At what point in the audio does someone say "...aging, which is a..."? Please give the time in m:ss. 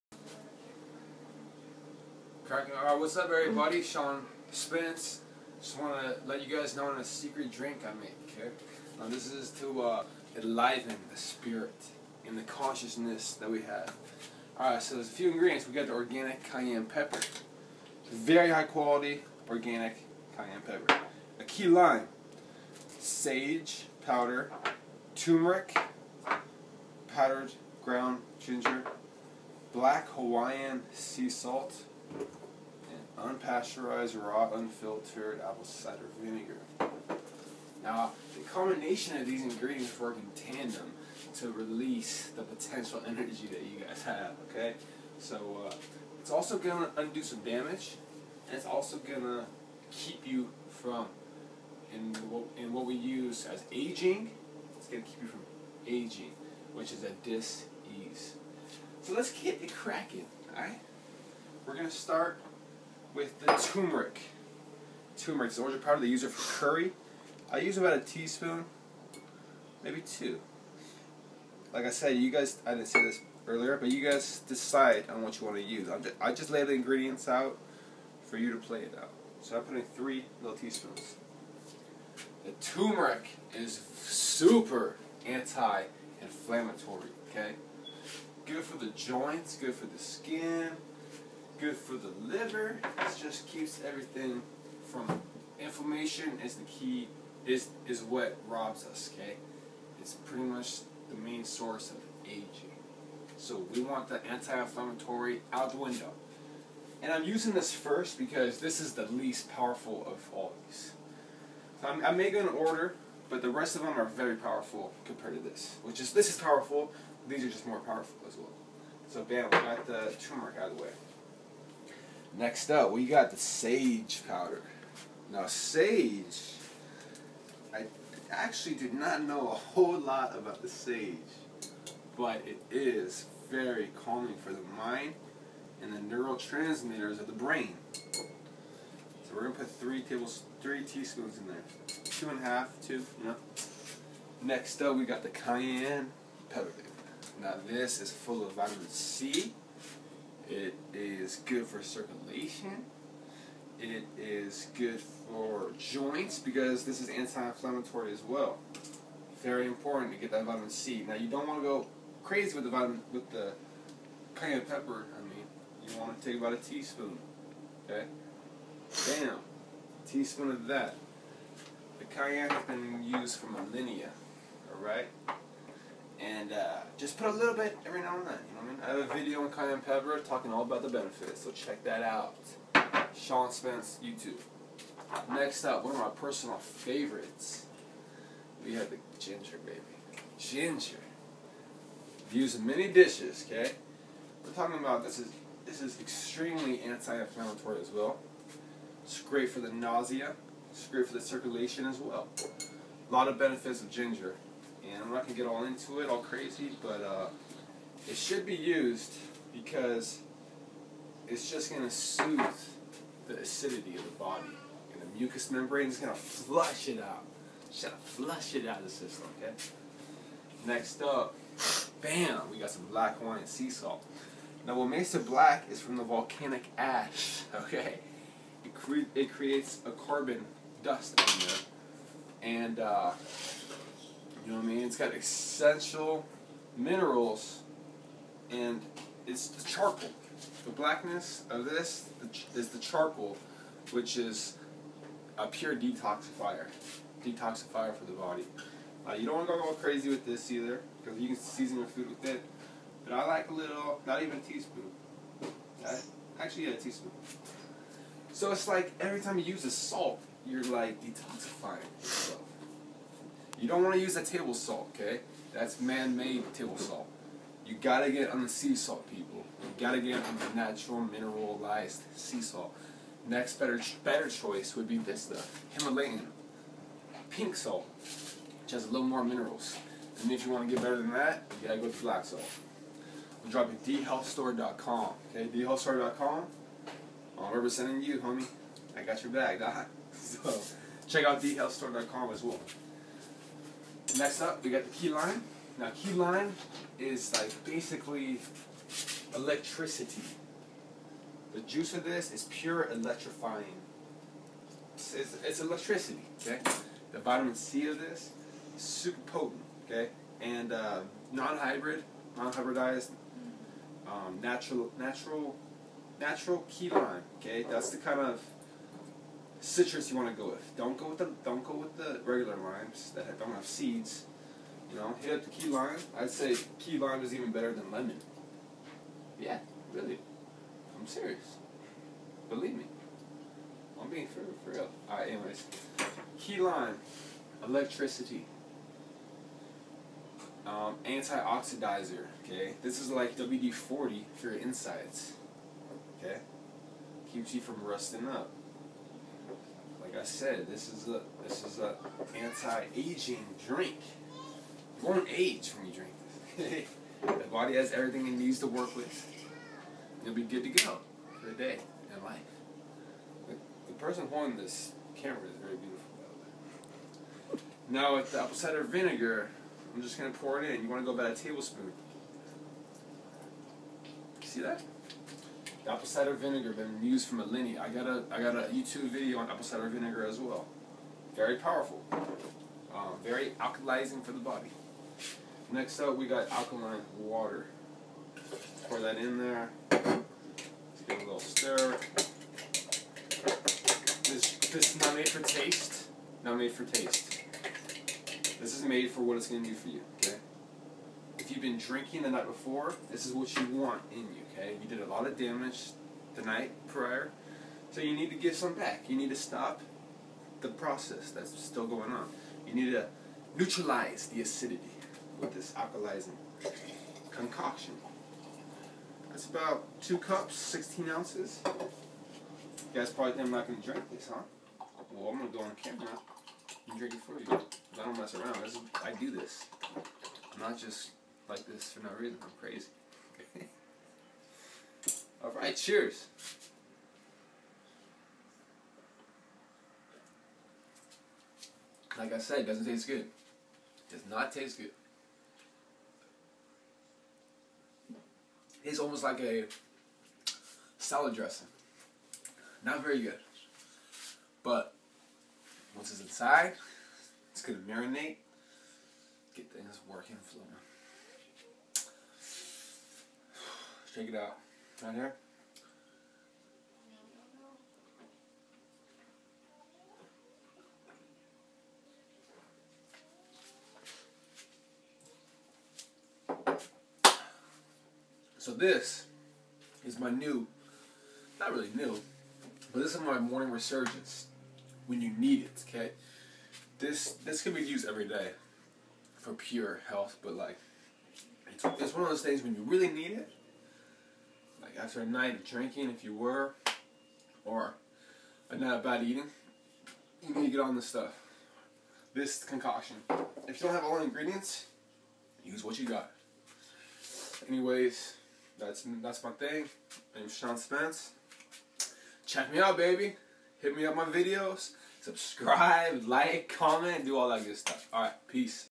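0:55.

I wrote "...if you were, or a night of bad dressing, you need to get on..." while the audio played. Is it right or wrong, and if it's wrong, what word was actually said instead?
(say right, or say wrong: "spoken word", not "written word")
wrong: "eating", not "dressing".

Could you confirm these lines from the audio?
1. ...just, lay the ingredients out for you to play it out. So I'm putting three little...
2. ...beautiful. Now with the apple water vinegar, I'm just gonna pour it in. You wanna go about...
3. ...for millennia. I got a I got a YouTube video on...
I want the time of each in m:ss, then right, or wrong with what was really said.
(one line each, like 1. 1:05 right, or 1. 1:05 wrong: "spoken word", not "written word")
1. 1:16 right
2. 6:05 wrong: "cider", not "water"
3. 6:17 right.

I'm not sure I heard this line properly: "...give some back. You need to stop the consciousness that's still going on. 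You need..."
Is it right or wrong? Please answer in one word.
wrong.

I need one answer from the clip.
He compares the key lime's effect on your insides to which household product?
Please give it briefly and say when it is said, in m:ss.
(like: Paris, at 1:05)
WD-40, at 5:43.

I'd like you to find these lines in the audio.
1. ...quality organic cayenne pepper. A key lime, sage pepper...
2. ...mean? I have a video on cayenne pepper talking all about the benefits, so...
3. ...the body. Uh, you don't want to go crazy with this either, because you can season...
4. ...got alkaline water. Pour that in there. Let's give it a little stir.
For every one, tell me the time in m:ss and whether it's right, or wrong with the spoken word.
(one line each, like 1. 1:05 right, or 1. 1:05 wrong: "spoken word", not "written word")
1. 0:18 wrong: "powder", not "pepper"
2. 2:58 right
3. 4:08 right
4. 6:26 right.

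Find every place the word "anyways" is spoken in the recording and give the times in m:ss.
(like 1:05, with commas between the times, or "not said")
5:35, 8:27.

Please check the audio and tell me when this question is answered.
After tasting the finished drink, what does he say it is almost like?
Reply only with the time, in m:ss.
7:30.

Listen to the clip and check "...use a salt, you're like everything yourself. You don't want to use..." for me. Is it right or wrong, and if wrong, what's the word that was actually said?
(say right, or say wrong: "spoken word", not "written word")
wrong: "detoxifying", not "everything".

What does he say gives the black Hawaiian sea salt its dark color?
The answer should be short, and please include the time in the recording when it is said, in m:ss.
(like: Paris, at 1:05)
Volcanic ash, at 3:46.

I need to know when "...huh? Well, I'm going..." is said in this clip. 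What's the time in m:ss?
7:04.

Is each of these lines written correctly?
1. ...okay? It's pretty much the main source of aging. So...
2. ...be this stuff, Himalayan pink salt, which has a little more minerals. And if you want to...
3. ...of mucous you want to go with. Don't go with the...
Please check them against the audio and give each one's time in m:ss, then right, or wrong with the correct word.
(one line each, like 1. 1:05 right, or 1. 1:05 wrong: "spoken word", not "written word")
1. 1:39 right
2. 4:34 right
3. 5:18 wrong: "citrus", not "mucous".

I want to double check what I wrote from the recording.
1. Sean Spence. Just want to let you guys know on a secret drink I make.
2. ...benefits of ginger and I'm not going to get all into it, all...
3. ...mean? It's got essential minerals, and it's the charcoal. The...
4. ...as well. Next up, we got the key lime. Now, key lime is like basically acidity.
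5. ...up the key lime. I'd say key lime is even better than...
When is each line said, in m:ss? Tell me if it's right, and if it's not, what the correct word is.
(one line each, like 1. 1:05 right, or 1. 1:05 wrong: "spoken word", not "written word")
1. 0:03 right
2. 3:23 right
3. 3:54 right
4. 4:52 wrong: "electricity", not "acidity"
5. 5:25 right.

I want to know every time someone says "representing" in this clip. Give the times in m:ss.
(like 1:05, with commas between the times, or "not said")
4:47.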